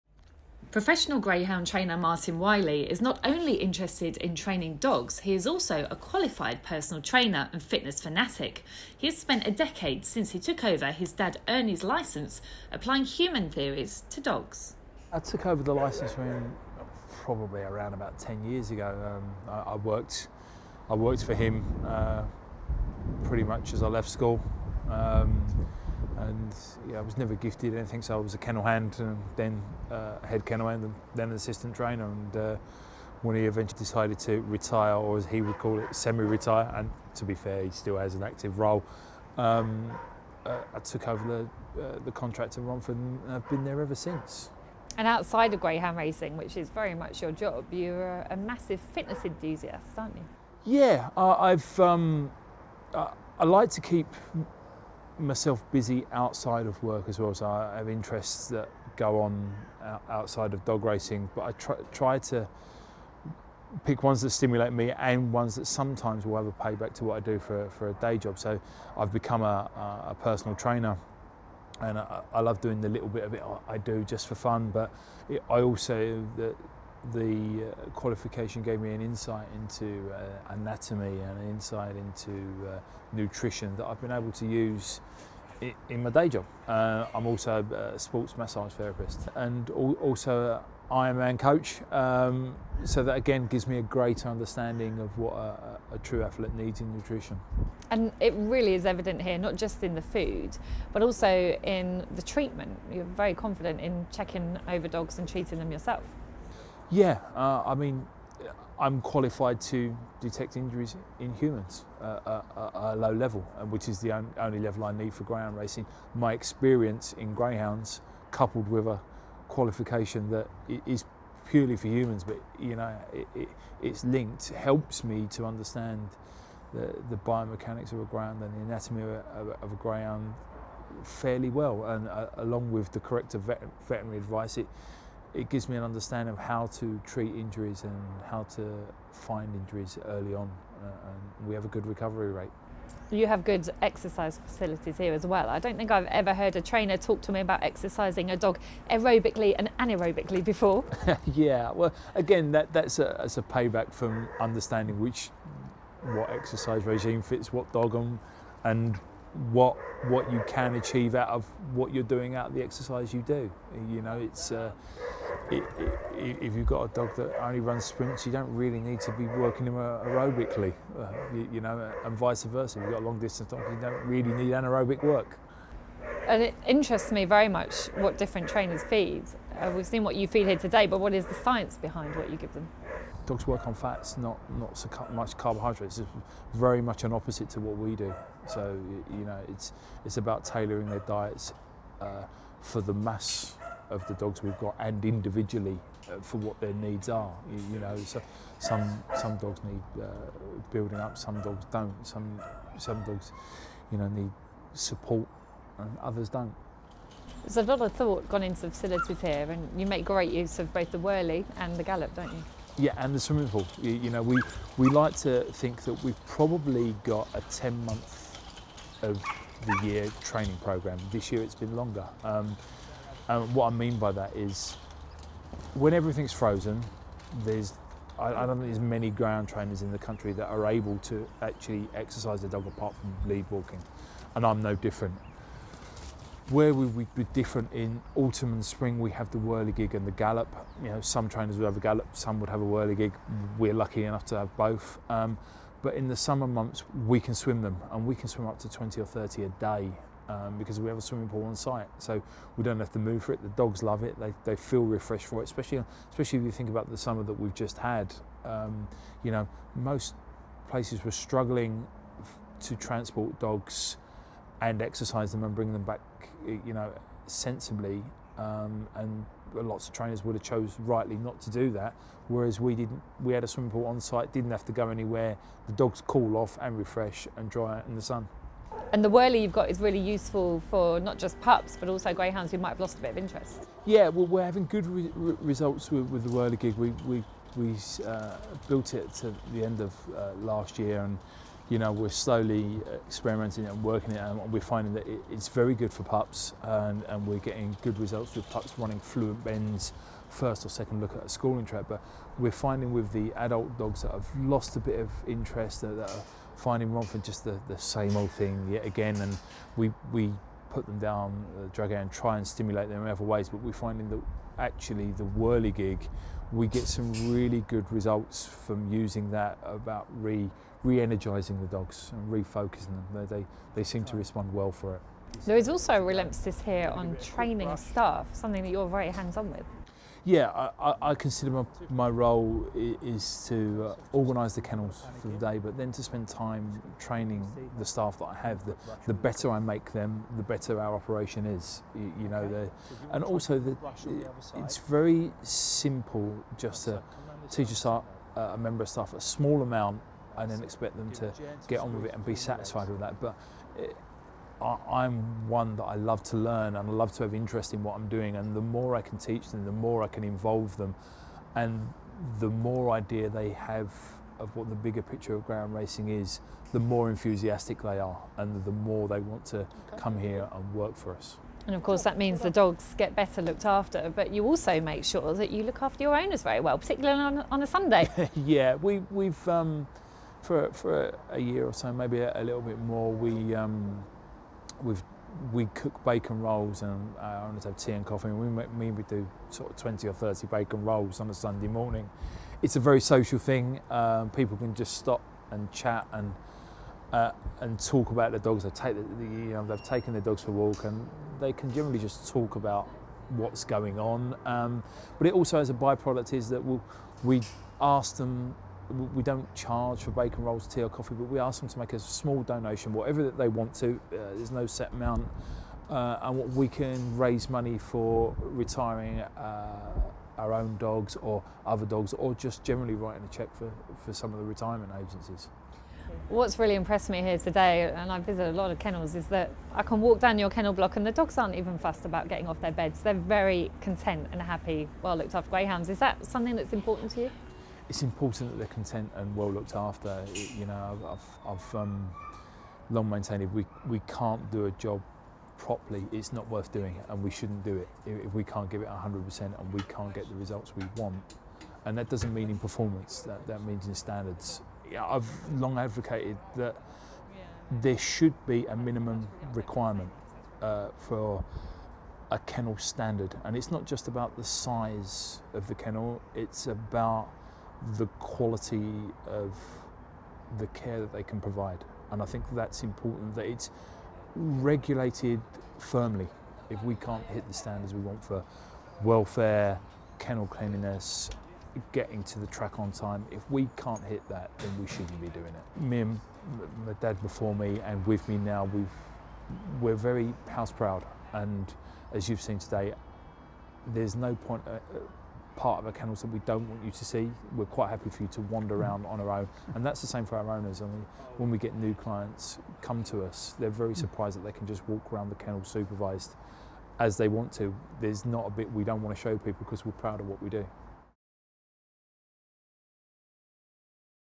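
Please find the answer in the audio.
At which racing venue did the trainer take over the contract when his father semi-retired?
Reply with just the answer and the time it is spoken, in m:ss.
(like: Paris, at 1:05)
Romford, at 0:42.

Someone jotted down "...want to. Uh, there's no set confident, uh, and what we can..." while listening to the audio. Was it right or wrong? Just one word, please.
wrong.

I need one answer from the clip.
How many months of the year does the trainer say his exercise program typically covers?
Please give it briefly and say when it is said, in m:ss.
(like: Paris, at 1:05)
10, at 3:37.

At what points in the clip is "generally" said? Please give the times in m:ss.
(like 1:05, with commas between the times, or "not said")
6:41, 7:02.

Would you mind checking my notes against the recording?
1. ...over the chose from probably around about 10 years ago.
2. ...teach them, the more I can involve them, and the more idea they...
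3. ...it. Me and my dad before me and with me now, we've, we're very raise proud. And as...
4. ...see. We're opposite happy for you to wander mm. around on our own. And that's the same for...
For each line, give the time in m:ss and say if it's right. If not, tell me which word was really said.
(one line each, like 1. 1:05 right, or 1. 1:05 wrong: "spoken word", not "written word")
1. 0:15 wrong: "license", not "chose"
2. 5:59 right
3. 8:05 wrong: "house", not "raise"
4. 8:17 wrong: "quite", not "opposite".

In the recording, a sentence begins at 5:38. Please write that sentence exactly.
The, the better I make them, the better our operation is.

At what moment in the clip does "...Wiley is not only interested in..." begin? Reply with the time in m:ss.
0:02.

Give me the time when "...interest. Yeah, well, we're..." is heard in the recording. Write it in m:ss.
4:43.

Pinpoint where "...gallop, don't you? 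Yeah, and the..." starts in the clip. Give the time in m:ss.
3:31.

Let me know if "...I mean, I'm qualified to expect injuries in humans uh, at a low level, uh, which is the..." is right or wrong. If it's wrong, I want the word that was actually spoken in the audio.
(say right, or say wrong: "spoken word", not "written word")
wrong: "detect", not "expect".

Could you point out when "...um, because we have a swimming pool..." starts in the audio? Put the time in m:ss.
4:10.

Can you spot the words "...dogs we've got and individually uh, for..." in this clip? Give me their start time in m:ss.
3:14.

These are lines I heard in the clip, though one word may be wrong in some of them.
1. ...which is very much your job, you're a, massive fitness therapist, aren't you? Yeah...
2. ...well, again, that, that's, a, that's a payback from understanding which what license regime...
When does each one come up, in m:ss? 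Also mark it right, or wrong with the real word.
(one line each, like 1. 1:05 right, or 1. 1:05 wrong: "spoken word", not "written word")
1. 0:46 wrong: "enthusiast", not "therapist"
2. 2:31 wrong: "exercise", not "license".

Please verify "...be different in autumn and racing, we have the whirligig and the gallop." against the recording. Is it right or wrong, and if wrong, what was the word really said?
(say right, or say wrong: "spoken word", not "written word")
wrong: "spring", not "racing".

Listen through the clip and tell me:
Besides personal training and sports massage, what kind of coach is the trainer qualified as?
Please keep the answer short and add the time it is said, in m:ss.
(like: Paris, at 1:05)
Ironman coach, at 1:31.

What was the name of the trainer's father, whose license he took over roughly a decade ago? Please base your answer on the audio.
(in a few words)
Ernie.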